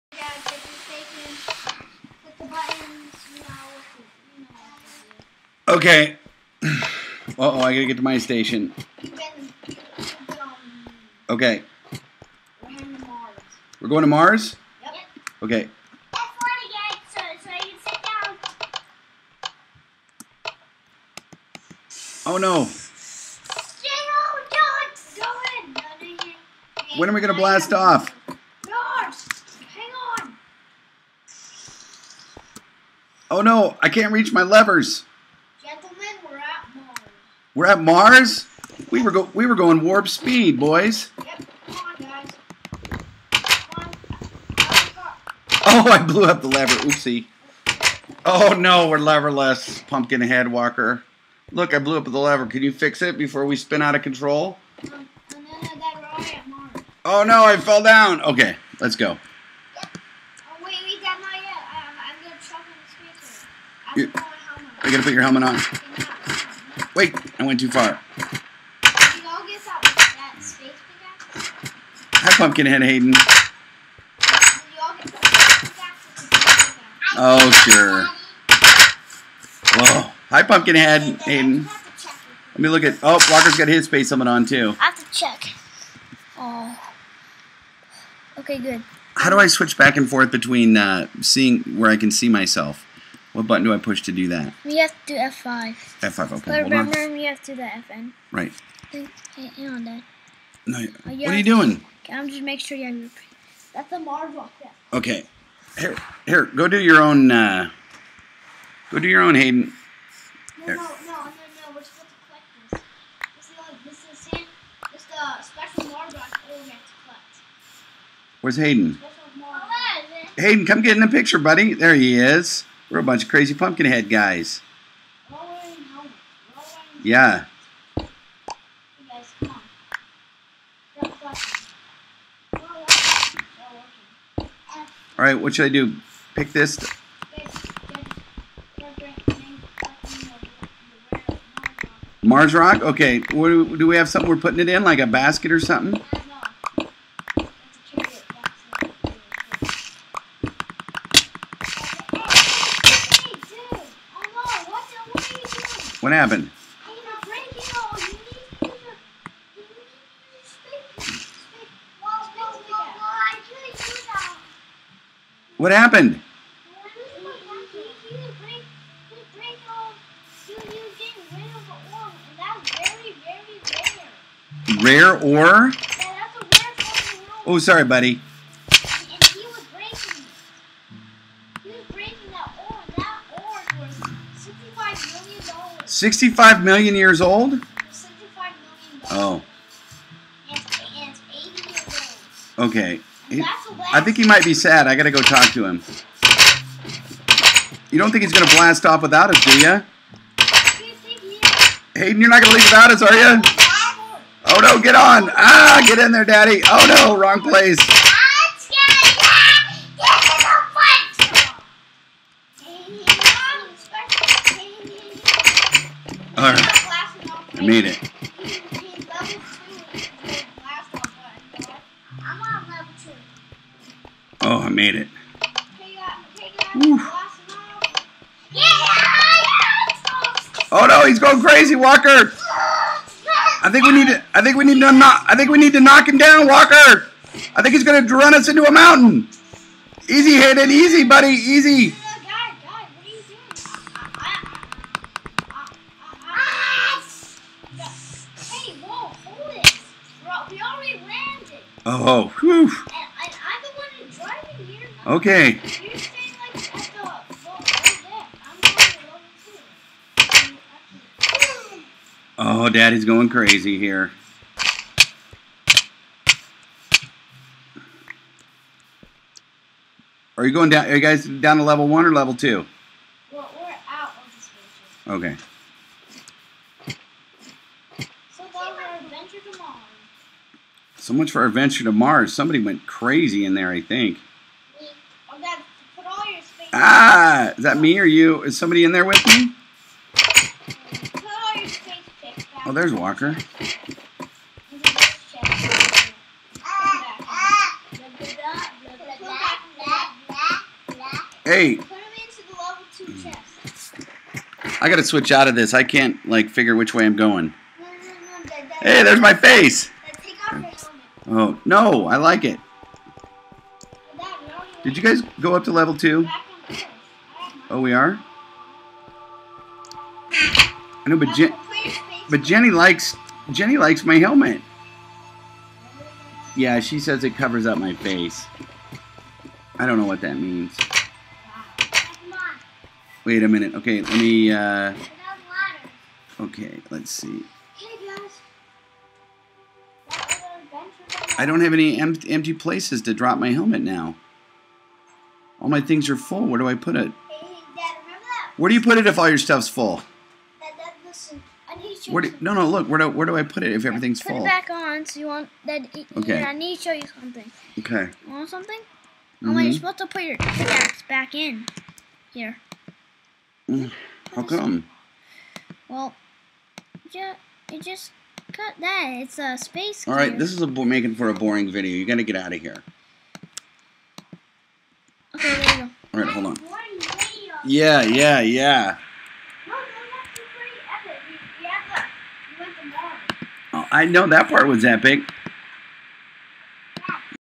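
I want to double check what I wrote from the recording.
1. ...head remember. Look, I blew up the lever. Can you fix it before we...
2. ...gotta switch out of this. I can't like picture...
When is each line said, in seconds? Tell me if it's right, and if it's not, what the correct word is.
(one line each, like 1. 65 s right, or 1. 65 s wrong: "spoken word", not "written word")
1. 50 s wrong: "walker", not "remember"
2. 304 s wrong: "figure", not "picture".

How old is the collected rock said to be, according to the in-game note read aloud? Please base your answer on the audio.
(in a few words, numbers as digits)
65 million years.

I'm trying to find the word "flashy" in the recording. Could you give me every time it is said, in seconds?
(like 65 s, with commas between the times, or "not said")
not said.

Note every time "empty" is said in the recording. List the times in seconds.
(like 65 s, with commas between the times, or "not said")
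341 s.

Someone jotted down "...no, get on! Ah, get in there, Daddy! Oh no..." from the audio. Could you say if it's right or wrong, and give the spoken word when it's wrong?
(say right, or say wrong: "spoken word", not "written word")
right.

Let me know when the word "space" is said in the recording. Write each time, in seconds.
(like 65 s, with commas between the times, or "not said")
83 s, 369 s.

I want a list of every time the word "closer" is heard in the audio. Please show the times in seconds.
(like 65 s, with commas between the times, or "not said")
not said.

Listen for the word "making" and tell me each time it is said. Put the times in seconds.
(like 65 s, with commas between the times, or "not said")
102 s, 370 s.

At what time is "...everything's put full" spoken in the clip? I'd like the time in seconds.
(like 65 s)
353 s.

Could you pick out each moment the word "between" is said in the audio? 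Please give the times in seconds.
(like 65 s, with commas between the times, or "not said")
90 s.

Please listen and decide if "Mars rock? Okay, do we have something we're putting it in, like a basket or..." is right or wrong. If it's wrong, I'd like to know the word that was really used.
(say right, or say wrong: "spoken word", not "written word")
right.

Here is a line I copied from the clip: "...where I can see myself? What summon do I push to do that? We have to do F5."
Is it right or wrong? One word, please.
wrong.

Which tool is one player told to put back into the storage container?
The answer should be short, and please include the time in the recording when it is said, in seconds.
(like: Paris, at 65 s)
pickaxe, at 360 s.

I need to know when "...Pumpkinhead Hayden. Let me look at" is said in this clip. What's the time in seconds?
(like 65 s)
80 s.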